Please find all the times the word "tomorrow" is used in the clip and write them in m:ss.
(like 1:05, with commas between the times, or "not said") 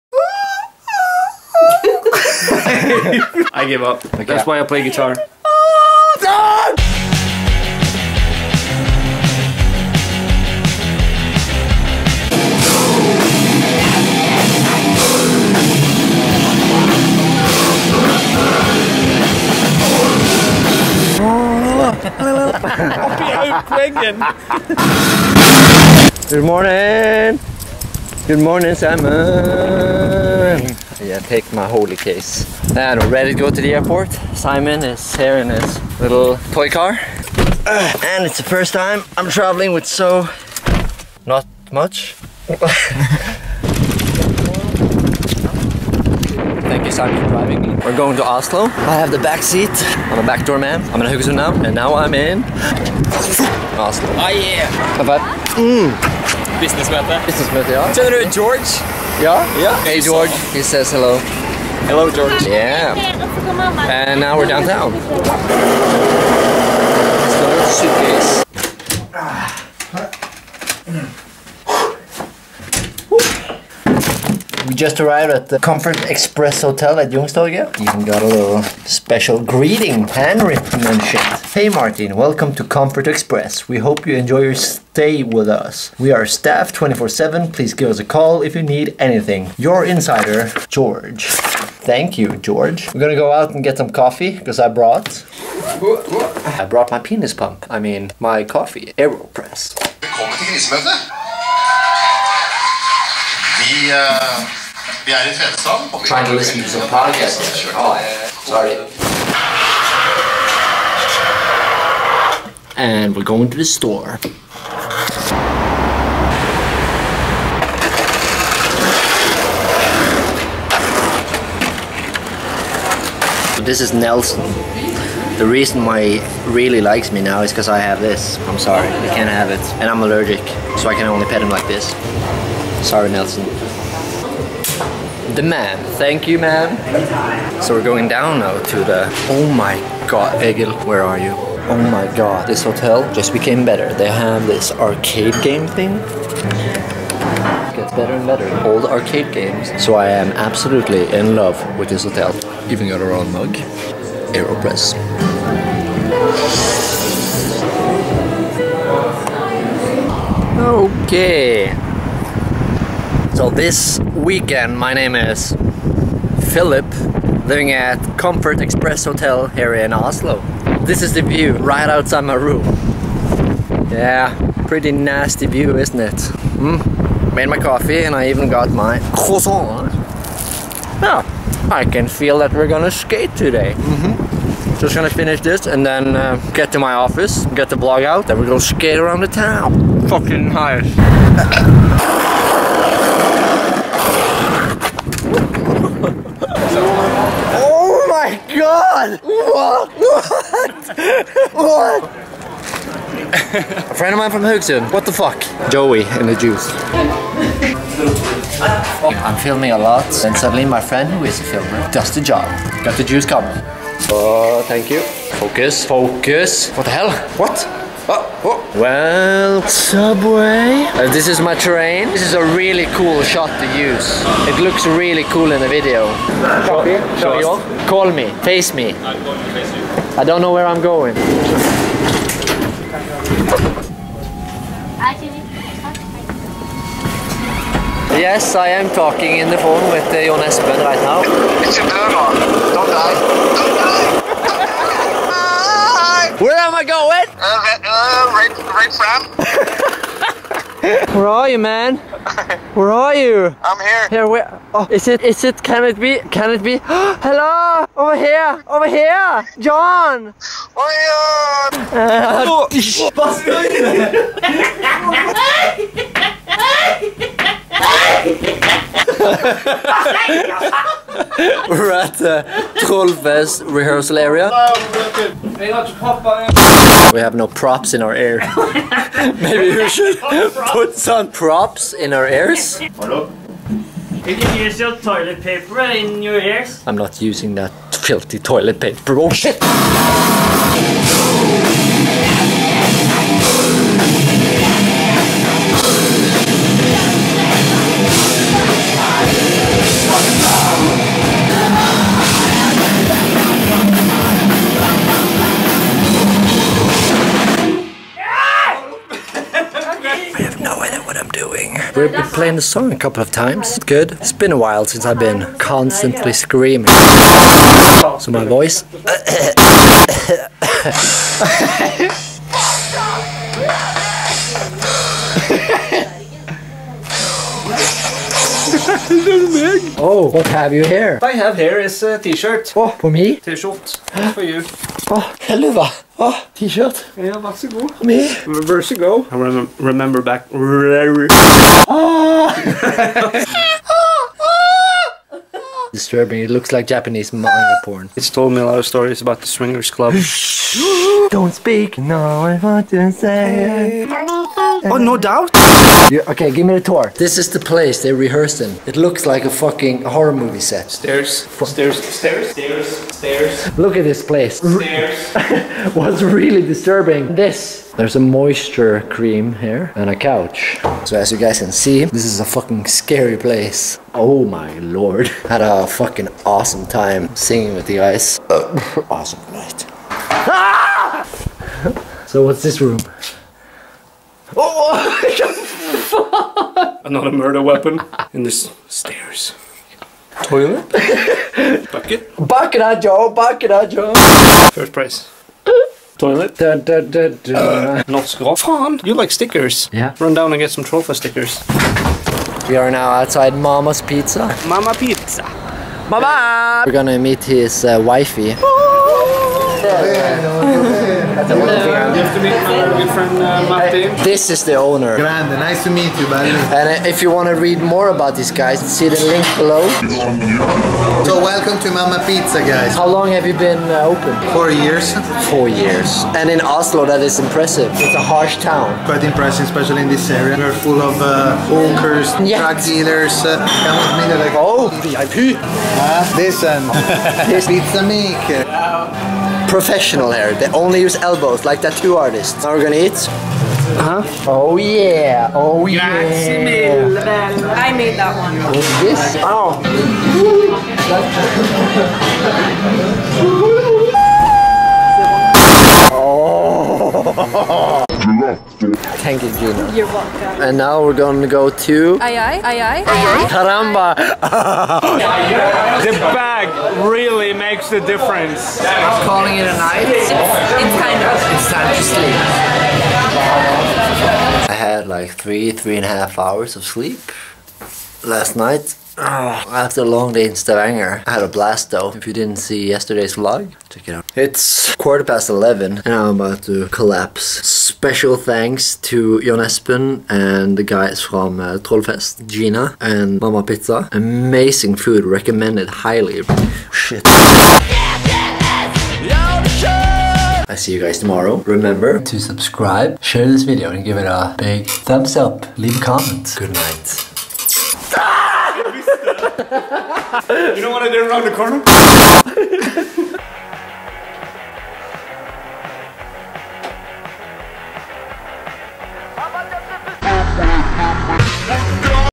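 8:21.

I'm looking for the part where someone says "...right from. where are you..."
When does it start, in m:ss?
4:08.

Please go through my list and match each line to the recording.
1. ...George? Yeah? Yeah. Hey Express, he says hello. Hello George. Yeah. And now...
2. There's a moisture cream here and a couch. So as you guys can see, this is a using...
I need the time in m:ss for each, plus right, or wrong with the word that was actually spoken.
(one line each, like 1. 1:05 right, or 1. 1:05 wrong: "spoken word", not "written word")
1. 0:58 wrong: "George", not "Express"
2. 6:07 wrong: "fucking", not "using".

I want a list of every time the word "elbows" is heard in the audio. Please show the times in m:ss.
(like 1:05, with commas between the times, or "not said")
7:21.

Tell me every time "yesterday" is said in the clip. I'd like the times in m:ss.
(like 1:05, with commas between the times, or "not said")
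8:02.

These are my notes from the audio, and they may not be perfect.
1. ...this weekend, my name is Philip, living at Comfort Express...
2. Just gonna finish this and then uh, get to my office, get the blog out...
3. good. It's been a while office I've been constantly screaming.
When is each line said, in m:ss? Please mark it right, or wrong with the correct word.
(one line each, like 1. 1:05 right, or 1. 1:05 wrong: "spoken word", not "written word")
1. 2:43 right
2. 3:04 right
3. 5:13 wrong: "since", not "office".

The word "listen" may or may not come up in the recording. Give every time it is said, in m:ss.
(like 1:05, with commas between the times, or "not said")
1:46, 7:16.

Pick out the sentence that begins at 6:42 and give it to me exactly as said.
We are now outside Mamma's Pizza.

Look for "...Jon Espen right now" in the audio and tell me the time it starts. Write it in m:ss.
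4:00.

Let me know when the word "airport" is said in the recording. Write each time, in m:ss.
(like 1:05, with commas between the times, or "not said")
0:33.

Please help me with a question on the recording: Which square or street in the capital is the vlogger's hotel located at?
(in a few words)
Youngstorget.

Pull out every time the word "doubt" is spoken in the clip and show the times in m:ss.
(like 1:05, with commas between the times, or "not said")
5:55.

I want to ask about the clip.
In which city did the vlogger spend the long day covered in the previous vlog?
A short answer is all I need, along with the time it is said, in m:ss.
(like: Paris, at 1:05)
Stavanger, at 8:00.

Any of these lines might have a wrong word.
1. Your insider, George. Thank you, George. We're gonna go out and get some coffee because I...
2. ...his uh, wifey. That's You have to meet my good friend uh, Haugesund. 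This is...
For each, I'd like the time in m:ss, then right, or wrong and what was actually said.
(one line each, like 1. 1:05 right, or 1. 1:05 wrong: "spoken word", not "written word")
1. 1:29 right
2. 6:47 wrong: "Martin", not "Haugesund".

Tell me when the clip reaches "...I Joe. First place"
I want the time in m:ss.
6:33.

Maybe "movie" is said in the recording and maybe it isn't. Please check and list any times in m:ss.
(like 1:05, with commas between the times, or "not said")
6:00.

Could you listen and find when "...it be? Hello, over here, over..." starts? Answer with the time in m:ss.
4:16.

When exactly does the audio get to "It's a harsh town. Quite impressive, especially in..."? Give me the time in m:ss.
7:07.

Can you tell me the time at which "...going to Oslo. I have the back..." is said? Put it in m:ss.
0:47.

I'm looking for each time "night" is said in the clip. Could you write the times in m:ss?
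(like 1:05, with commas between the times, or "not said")
6:19, 7:49, 7:58, 8:26.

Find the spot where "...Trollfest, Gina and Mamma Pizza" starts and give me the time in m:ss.
8:11.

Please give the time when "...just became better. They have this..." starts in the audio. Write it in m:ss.
2:23.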